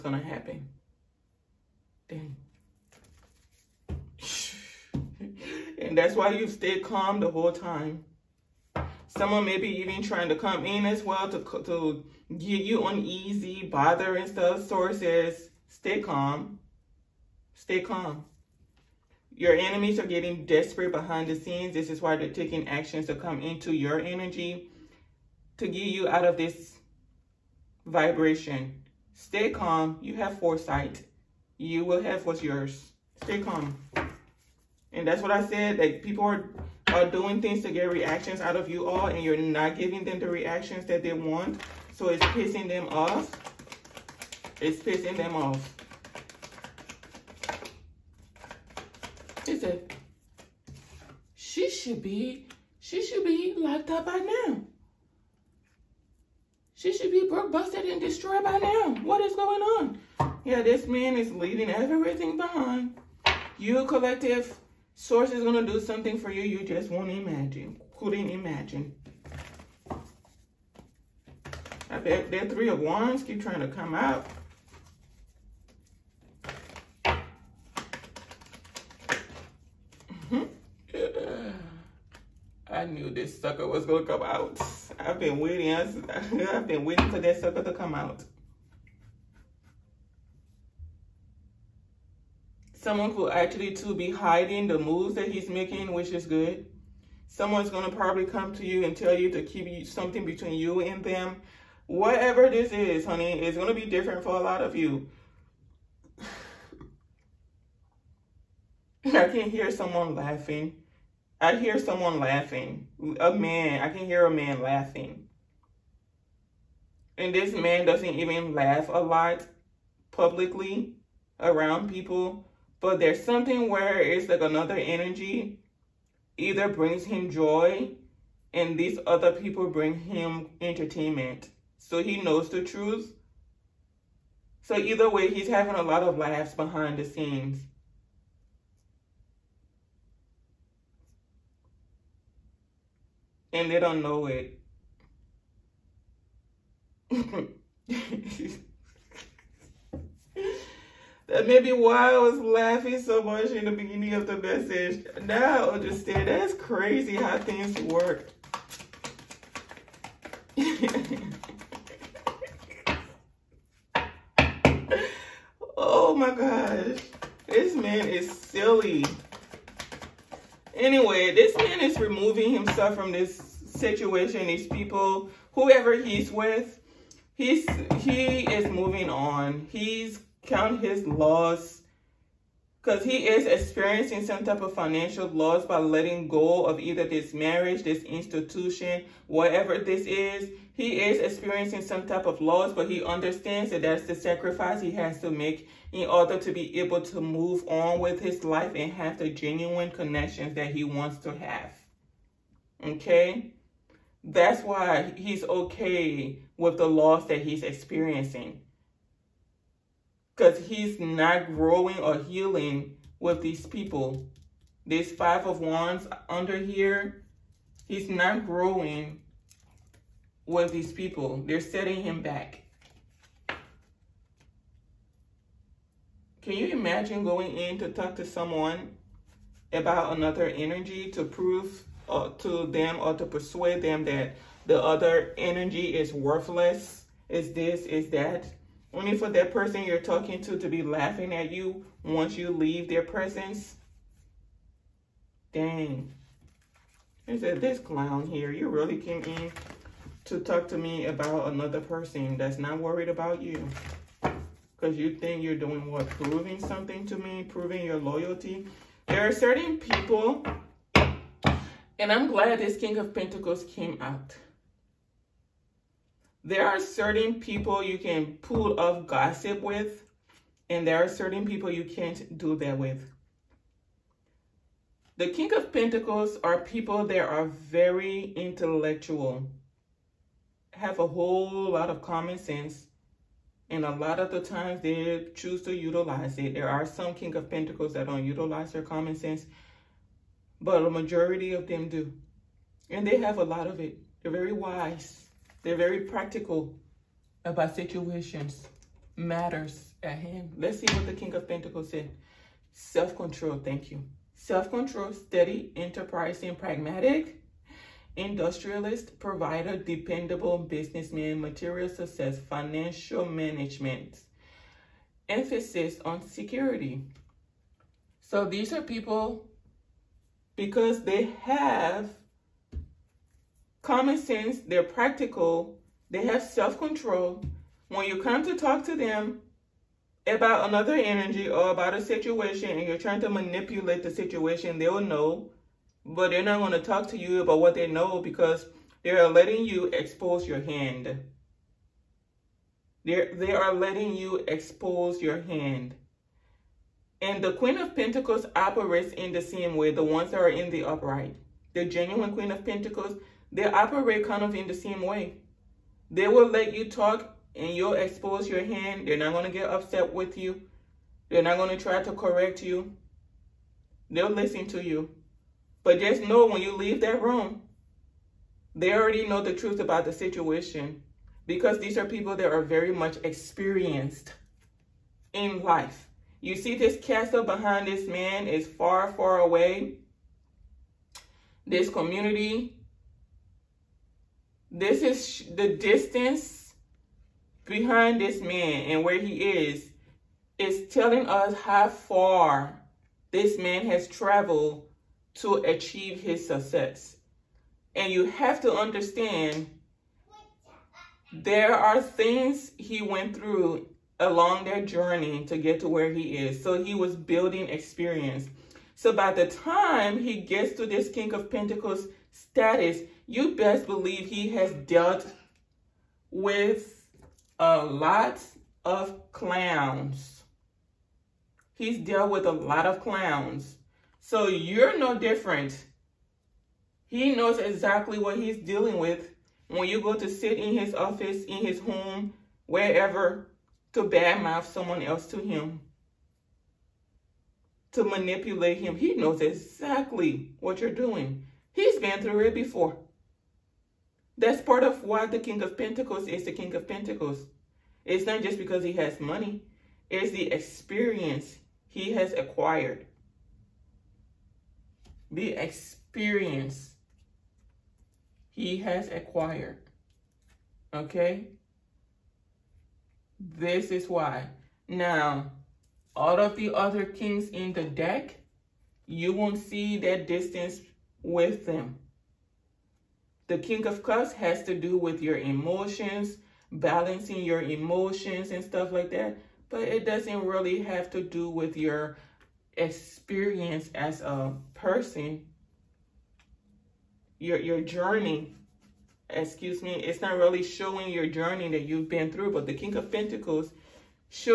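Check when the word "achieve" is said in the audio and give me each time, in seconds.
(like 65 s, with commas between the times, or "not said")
395 s.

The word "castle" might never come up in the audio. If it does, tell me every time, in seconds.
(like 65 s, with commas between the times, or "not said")
377 s.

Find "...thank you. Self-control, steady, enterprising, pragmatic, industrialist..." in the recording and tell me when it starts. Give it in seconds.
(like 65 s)
303 s.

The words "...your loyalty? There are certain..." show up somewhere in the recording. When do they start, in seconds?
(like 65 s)
257 s.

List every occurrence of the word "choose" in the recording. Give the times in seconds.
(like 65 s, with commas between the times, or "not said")
285 s.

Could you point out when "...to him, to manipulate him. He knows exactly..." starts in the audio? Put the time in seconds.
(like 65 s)
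435 s.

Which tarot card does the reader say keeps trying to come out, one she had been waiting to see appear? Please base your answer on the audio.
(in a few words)
Three of Wands.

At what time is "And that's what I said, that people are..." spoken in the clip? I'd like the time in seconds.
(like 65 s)
34 s.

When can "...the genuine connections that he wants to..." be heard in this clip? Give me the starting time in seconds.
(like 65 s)
199 s.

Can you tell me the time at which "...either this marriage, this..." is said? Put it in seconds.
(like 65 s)
186 s.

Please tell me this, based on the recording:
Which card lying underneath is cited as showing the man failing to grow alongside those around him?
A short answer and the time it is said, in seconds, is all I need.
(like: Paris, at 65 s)
Five of Wands, at 215 s.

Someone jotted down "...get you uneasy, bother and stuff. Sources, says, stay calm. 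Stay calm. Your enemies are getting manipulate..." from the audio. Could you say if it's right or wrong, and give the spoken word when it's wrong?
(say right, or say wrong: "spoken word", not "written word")
wrong: "desperate", not "manipulate".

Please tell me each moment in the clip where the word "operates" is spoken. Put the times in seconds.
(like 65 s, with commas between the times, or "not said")
348 s, 353 s.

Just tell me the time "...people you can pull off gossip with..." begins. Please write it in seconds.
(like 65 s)
267 s.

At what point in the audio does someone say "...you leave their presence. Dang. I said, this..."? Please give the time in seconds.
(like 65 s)
242 s.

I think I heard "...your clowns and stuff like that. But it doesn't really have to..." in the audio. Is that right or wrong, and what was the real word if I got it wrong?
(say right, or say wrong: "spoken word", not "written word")
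wrong: "emotions", not "clowns".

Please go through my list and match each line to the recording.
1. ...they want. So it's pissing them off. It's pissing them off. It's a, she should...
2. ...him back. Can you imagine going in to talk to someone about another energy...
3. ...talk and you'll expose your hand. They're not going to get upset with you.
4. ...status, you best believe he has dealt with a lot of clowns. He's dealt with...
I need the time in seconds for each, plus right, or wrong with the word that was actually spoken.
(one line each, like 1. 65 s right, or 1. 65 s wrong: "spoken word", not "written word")
1. 41 s right
2. 222 s right
3. 356 s right
4. 412 s right.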